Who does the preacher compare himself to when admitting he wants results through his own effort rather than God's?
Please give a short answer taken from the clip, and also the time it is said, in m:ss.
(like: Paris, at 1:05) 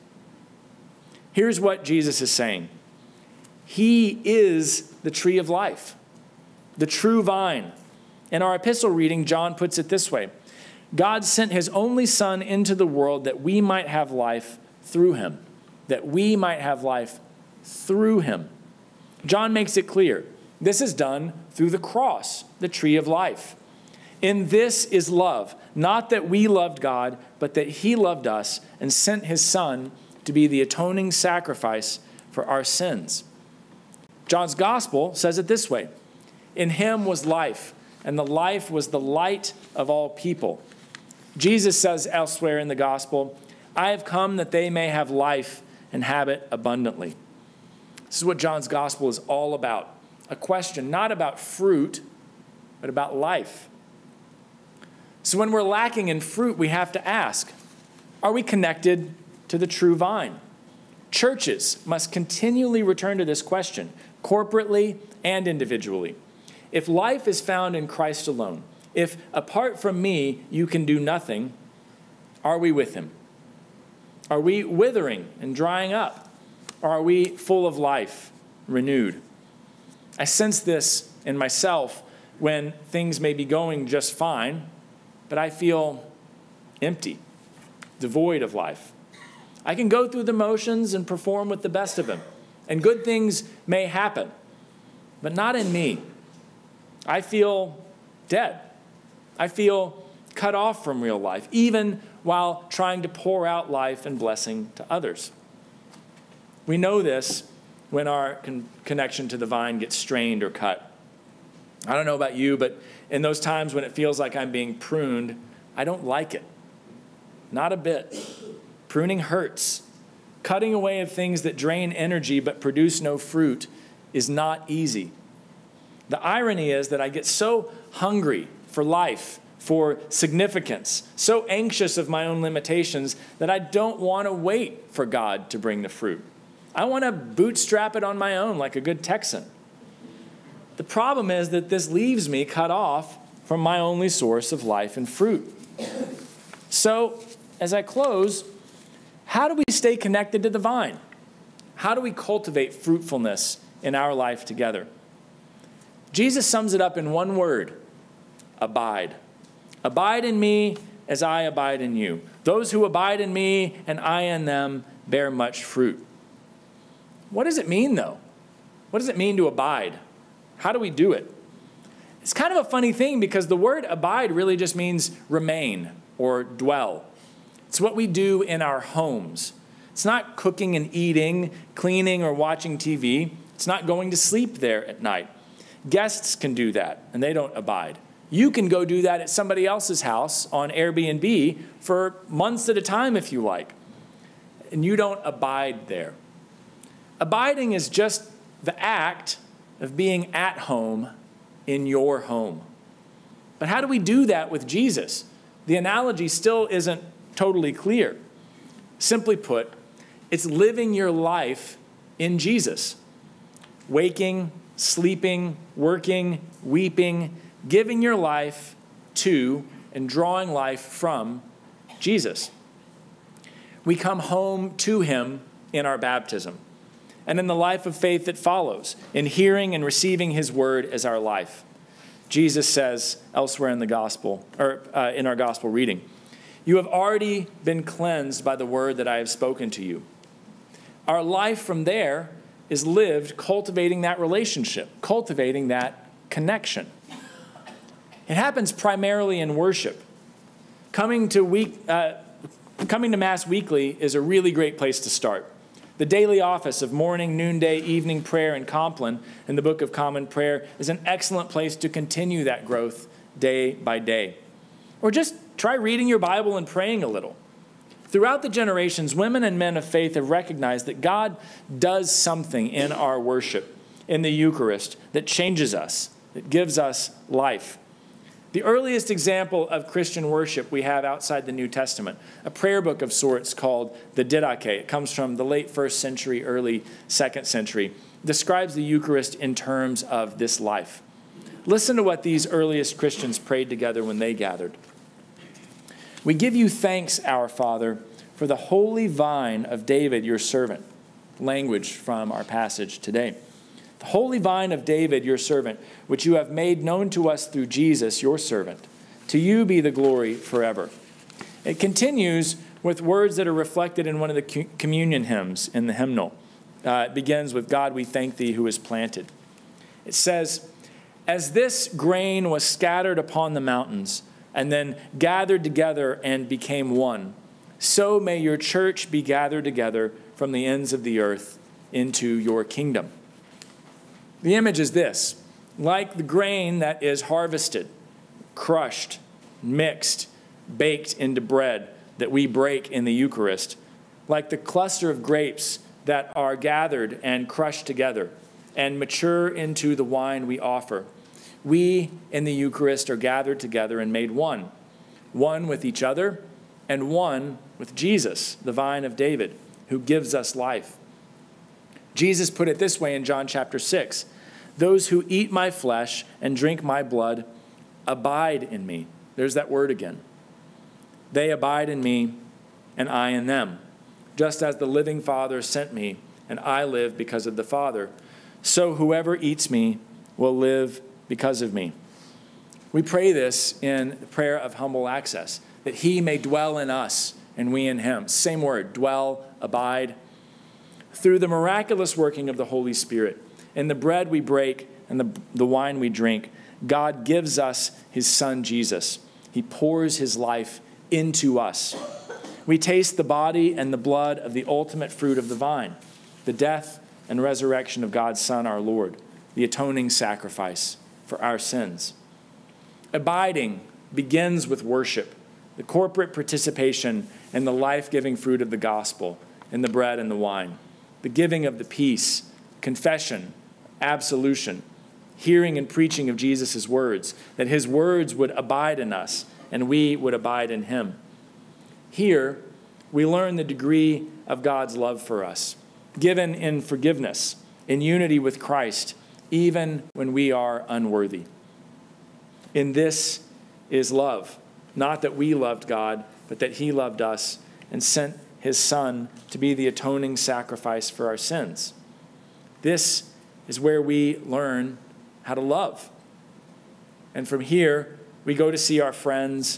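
A good Texan, at 2:18.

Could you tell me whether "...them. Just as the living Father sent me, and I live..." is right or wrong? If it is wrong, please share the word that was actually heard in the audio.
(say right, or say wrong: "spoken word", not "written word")
right.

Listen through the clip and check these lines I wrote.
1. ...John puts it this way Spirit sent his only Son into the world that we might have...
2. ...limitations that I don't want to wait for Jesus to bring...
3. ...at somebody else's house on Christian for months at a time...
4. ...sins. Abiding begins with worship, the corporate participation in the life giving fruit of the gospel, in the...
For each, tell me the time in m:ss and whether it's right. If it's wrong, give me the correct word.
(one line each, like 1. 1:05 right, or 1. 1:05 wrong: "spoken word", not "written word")
1. 0:09 wrong: "God", not "Spirit"
2. 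2:12 wrong: "God", not "Jesus"
3. 3:09 wrong: "Airbnb", not "Christian"
4. 6:51 right.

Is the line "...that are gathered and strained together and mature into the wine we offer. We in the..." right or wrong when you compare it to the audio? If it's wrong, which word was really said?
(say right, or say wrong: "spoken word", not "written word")
wrong: "crushed", not "strained".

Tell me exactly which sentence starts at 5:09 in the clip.
To you be the glory forever.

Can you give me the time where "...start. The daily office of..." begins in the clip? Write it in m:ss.
4:15.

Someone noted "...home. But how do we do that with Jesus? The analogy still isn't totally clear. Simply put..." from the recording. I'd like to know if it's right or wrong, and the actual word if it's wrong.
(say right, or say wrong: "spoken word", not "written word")
right.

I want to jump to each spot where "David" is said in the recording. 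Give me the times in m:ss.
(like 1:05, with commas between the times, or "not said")
4:59, 5:04, 5:59.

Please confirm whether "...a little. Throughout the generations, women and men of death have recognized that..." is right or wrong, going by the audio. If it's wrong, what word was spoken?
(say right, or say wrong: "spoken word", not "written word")
wrong: "faith", not "death".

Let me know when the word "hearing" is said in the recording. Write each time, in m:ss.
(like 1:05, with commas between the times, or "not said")
3:49, 7:05.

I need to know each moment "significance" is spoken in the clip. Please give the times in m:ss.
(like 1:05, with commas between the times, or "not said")
2:10.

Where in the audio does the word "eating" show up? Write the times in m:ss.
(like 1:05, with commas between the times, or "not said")
3:00.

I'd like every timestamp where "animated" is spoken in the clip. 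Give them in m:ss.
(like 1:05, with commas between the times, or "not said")
not said.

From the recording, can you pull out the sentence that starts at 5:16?
Uh, it begins with, God, we thank thee who is planted.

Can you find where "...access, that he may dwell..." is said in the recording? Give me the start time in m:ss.
6:25.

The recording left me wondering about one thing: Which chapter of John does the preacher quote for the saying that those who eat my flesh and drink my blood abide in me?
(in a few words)
Chapter 6.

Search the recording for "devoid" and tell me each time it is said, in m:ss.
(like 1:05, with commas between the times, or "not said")
1:27.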